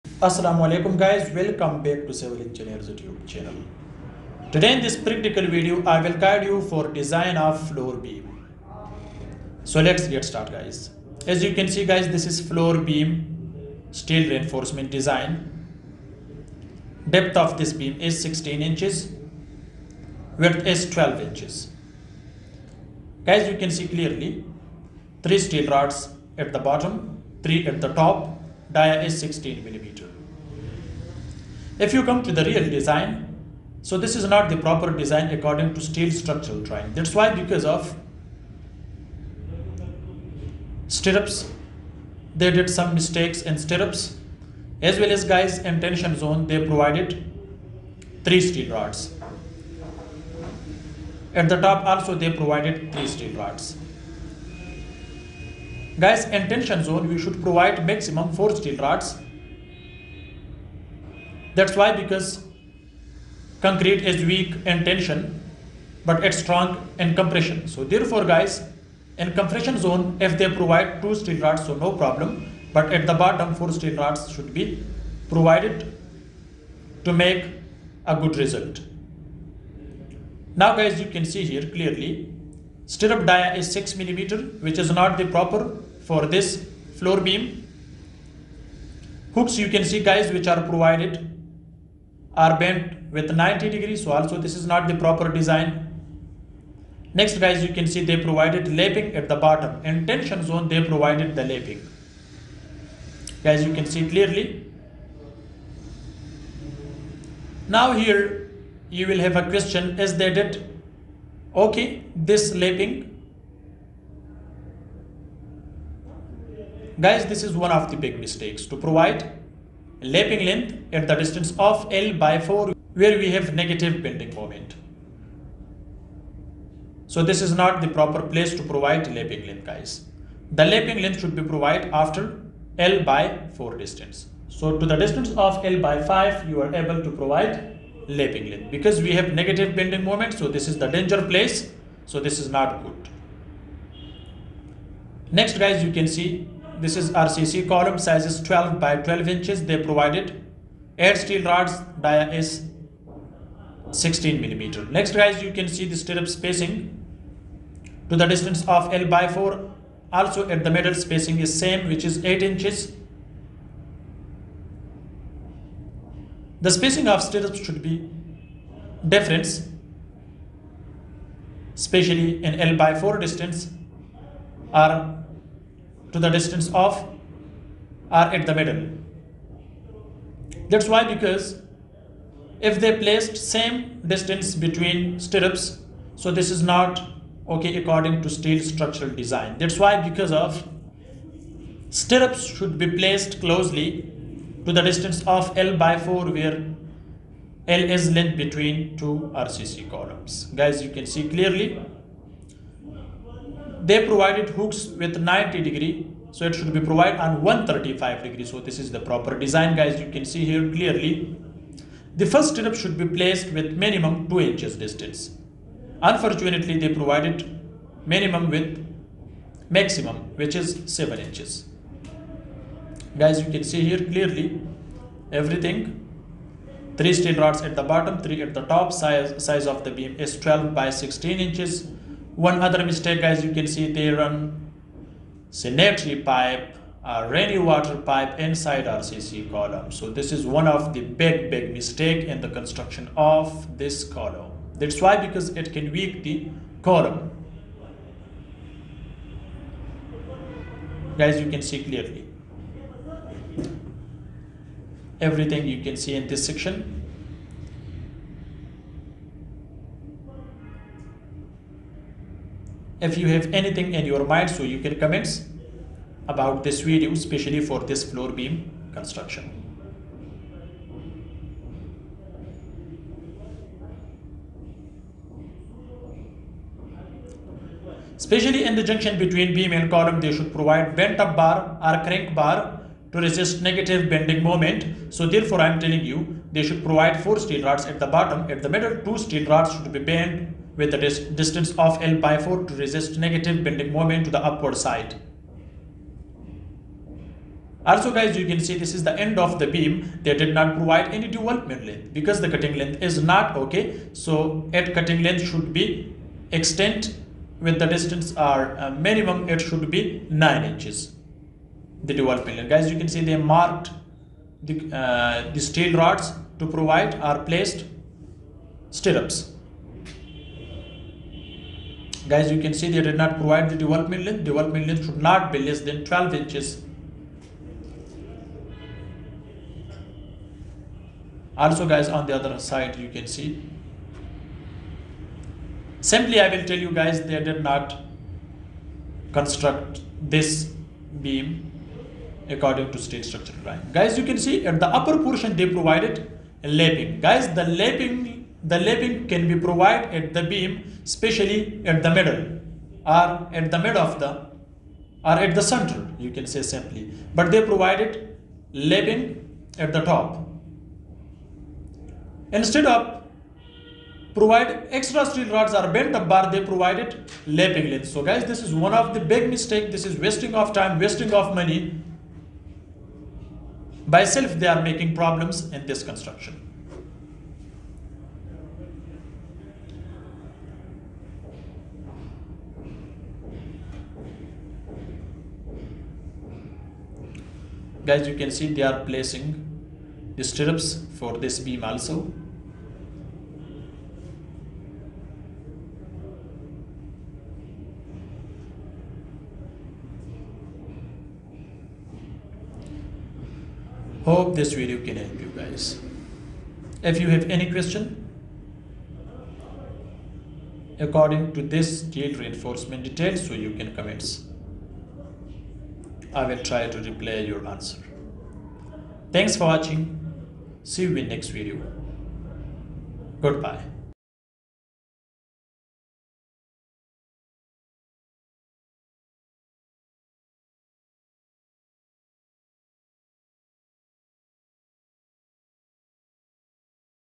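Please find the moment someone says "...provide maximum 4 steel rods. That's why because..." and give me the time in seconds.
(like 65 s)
57 s.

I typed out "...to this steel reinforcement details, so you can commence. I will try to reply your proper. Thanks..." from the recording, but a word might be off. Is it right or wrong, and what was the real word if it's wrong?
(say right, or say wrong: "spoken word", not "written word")
wrong: "answer", not "proper".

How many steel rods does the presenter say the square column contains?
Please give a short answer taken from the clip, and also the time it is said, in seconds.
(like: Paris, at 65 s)
8, at 150 s.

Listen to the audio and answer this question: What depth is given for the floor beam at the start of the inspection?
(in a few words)
16 inches.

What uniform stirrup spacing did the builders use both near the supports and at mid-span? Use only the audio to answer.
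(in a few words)
8 inches.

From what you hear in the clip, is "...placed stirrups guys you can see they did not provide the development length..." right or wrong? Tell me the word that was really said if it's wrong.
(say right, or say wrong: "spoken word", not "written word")
right.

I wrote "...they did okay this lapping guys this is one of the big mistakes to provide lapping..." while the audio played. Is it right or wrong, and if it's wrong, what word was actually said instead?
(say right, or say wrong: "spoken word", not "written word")
right.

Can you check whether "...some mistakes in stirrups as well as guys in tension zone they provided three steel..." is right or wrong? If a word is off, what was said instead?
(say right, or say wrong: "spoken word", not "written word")
right.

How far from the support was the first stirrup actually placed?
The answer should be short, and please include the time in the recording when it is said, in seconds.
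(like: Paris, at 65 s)
7 inches, at 220 s.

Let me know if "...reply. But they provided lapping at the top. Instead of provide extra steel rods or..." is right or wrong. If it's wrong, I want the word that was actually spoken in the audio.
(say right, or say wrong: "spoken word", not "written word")
wrong: "simply", not "reply".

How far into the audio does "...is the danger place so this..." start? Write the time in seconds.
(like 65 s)
140 s.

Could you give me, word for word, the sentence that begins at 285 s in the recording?
So therefore I am telling you they should provide 4 steel rods at the bottom.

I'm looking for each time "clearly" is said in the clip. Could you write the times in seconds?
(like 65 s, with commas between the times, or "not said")
23 s, 81 s, 104 s, 201 s, 210 s, 224 s, 251 s.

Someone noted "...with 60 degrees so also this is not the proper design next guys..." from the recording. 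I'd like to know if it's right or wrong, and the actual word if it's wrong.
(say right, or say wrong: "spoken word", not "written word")
wrong: "90", not "60".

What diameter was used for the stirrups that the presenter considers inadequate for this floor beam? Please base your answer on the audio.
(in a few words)
6 millimeter.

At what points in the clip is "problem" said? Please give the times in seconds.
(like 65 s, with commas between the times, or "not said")
71 s, 375 s.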